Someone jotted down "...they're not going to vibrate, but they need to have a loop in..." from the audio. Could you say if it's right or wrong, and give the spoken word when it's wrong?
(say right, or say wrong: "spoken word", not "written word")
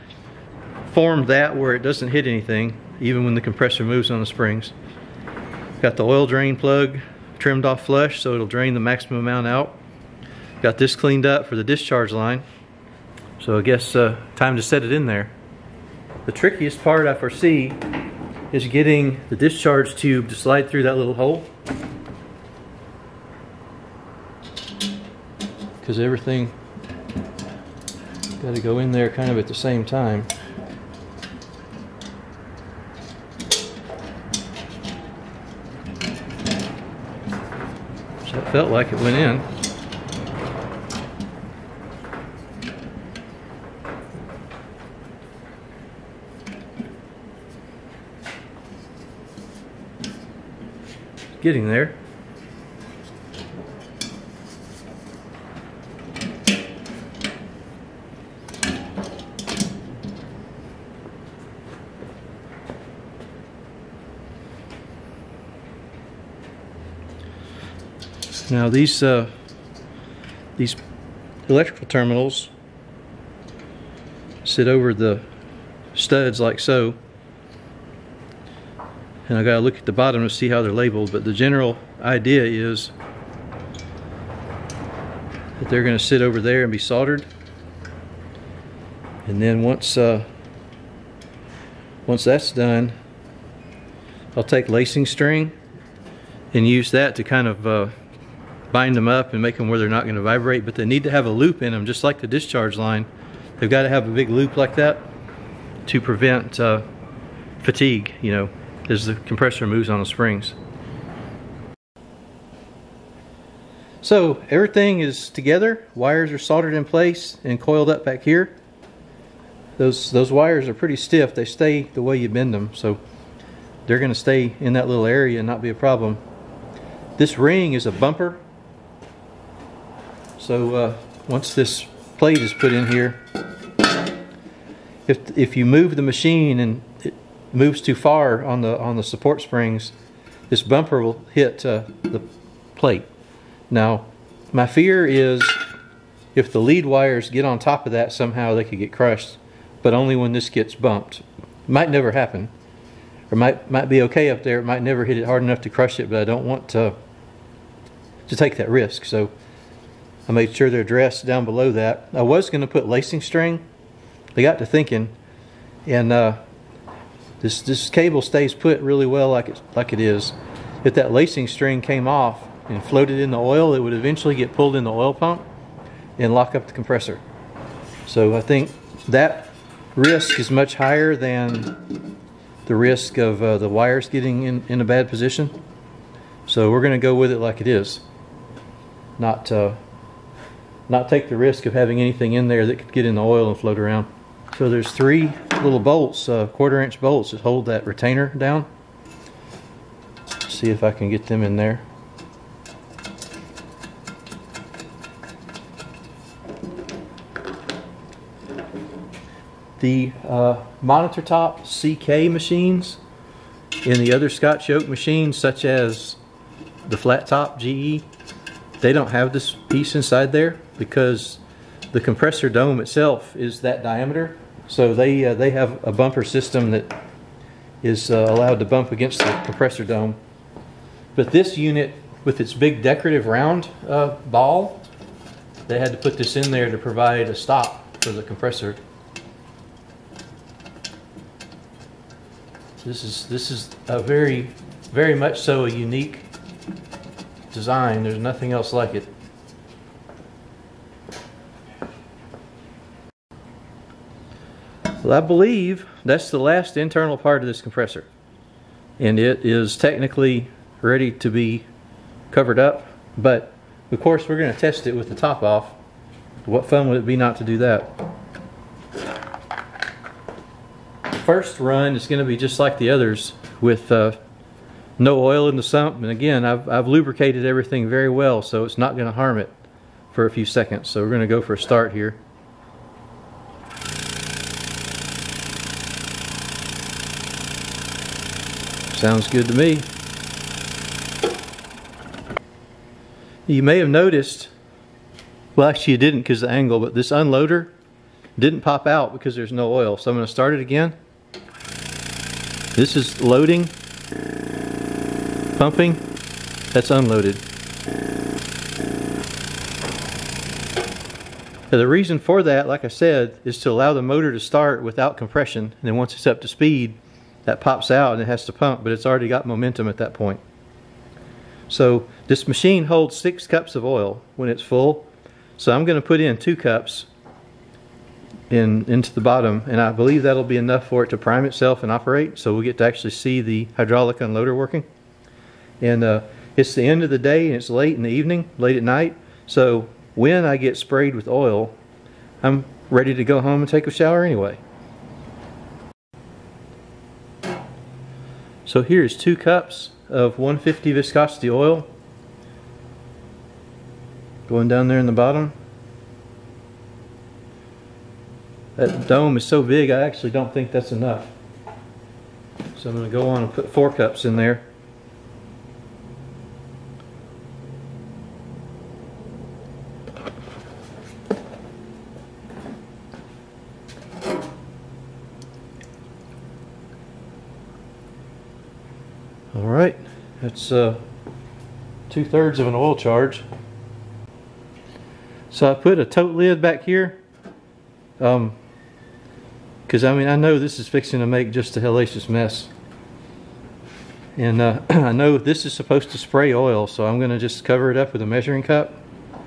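right.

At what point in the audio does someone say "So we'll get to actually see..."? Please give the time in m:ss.
5:32.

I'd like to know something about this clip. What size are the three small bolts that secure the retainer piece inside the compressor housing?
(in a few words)
quarter inch.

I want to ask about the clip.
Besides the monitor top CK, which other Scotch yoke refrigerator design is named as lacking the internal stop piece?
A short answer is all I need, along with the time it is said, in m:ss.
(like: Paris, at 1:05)
flat top GE, at 3:36.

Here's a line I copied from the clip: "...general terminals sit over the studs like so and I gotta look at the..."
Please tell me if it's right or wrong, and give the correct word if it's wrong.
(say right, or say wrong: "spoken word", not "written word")
wrong: "electrical", not "general".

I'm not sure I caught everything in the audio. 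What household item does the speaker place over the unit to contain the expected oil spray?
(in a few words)
measuring cup.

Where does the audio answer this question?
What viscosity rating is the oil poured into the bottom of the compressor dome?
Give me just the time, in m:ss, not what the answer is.
5:50.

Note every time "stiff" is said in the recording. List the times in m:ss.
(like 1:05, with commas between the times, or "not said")
2:00.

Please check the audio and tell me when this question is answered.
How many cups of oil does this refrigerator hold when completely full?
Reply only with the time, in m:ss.
5:23.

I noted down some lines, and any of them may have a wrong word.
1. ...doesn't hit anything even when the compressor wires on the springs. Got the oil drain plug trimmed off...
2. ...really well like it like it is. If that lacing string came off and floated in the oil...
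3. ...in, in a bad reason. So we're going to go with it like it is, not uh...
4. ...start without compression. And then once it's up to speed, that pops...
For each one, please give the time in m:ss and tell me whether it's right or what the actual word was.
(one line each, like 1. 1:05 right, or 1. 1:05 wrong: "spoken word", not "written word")
1. 0:01 wrong: "moves", not "wires"
2. 2:48 right
3. 3:04 wrong: "position", not "reason"
4. 5:14 right.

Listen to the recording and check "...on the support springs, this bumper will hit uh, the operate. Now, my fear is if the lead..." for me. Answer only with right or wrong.
wrong.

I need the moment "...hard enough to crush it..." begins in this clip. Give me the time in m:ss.
2:35.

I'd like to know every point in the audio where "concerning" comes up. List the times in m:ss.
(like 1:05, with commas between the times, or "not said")
not said.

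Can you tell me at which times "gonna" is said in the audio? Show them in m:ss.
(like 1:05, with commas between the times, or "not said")
1:25, 2:03, 6:37.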